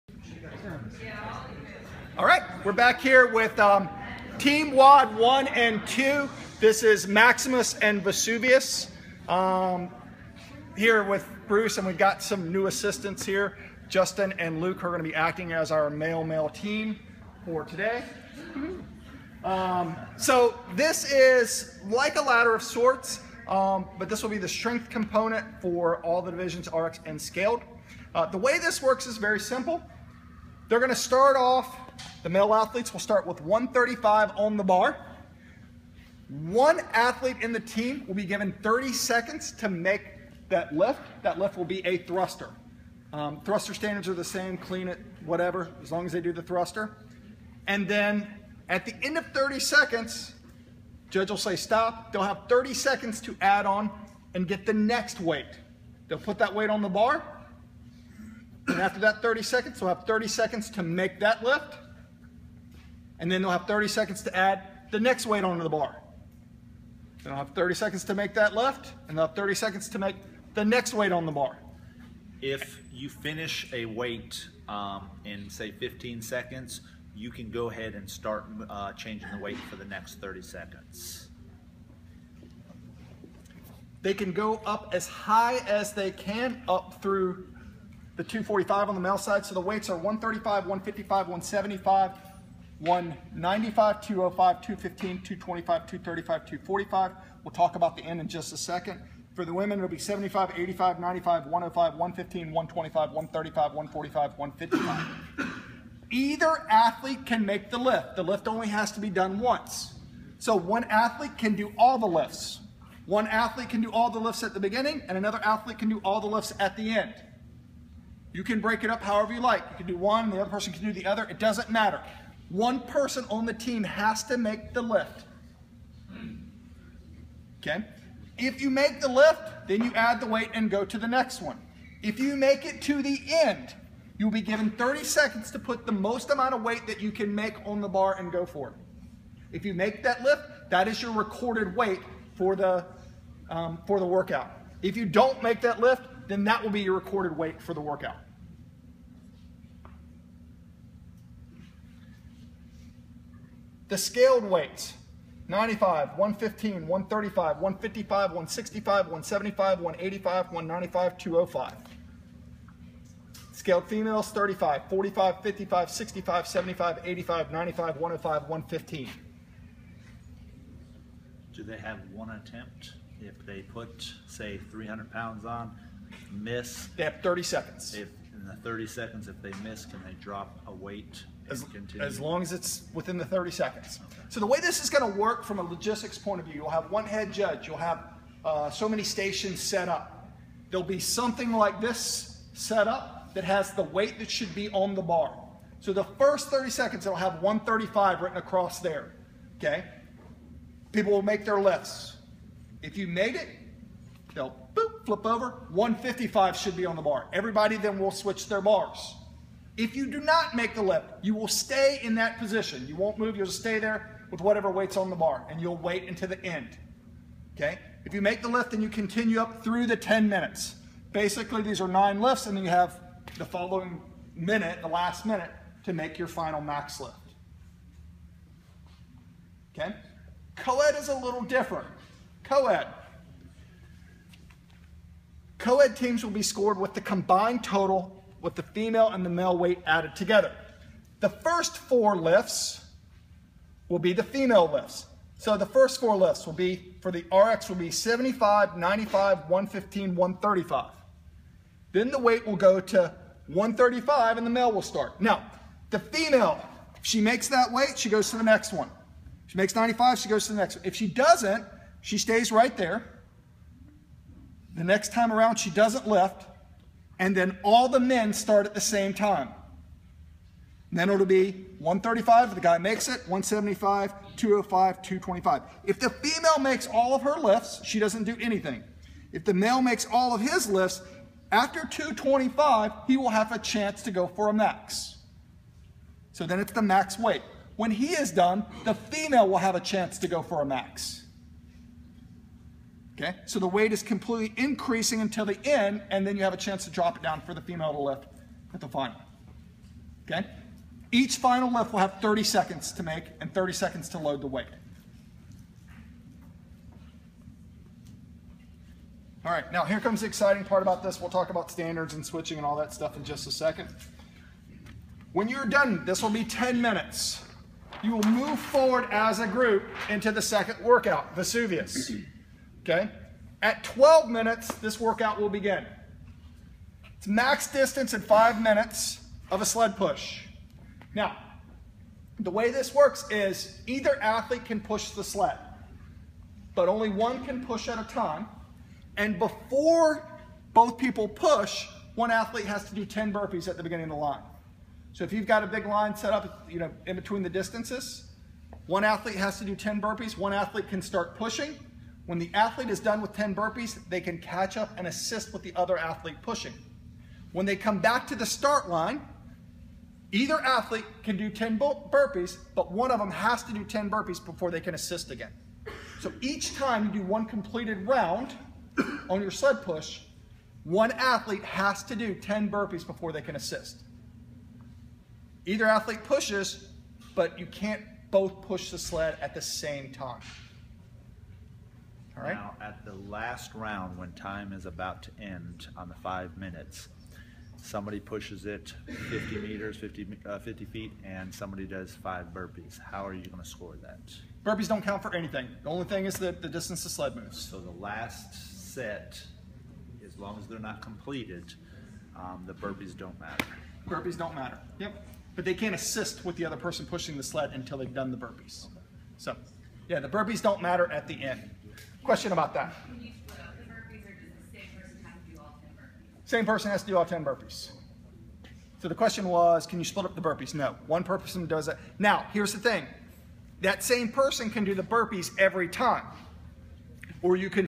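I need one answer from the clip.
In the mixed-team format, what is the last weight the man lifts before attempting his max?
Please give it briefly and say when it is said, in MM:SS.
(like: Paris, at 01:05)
225, at 04:41.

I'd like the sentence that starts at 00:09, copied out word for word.
Um, here with Bruce, and we've got some new assistants here.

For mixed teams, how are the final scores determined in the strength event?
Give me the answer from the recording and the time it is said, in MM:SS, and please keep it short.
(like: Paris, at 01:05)
combined total, at 03:57.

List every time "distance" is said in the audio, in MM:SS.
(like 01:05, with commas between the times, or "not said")
05:27, 05:47, 06:36.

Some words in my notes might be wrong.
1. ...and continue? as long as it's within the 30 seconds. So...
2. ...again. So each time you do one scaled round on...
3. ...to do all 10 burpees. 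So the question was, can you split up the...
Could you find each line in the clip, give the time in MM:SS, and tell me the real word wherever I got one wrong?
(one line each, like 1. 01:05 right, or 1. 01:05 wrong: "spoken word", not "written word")
1. 03:01 right
2. 06:05 wrong: "completed", not "scaled"
3. 06:57 right.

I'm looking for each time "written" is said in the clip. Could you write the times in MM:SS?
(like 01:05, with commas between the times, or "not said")
03:18.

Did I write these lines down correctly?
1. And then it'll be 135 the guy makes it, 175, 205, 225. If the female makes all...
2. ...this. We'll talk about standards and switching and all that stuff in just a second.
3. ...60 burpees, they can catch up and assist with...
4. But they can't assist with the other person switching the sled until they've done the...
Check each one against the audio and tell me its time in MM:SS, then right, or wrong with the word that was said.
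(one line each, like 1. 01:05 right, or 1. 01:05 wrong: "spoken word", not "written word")
1. 04:30 right
2. 05:11 right
3. 05:53 wrong: "10", not "60"
4. 06:45 wrong: "pushing", not "switching".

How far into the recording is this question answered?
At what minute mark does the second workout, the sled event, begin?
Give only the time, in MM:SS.
05:23.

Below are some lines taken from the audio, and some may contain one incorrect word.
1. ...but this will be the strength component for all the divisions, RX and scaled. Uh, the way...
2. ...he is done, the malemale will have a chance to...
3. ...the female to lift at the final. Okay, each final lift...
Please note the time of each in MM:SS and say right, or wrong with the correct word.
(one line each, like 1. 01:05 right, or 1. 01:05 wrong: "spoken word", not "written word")
1. 00:23 right
2. 04:47 wrong: "female", not "malemale"
3. 04:57 right.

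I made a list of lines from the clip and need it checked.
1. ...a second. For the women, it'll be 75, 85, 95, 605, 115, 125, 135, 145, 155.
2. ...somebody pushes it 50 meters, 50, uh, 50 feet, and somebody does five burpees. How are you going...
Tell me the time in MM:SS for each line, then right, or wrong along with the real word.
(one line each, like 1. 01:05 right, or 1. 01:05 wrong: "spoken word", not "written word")
1. 01:38 wrong: "105", not "605"
2. 06:27 right.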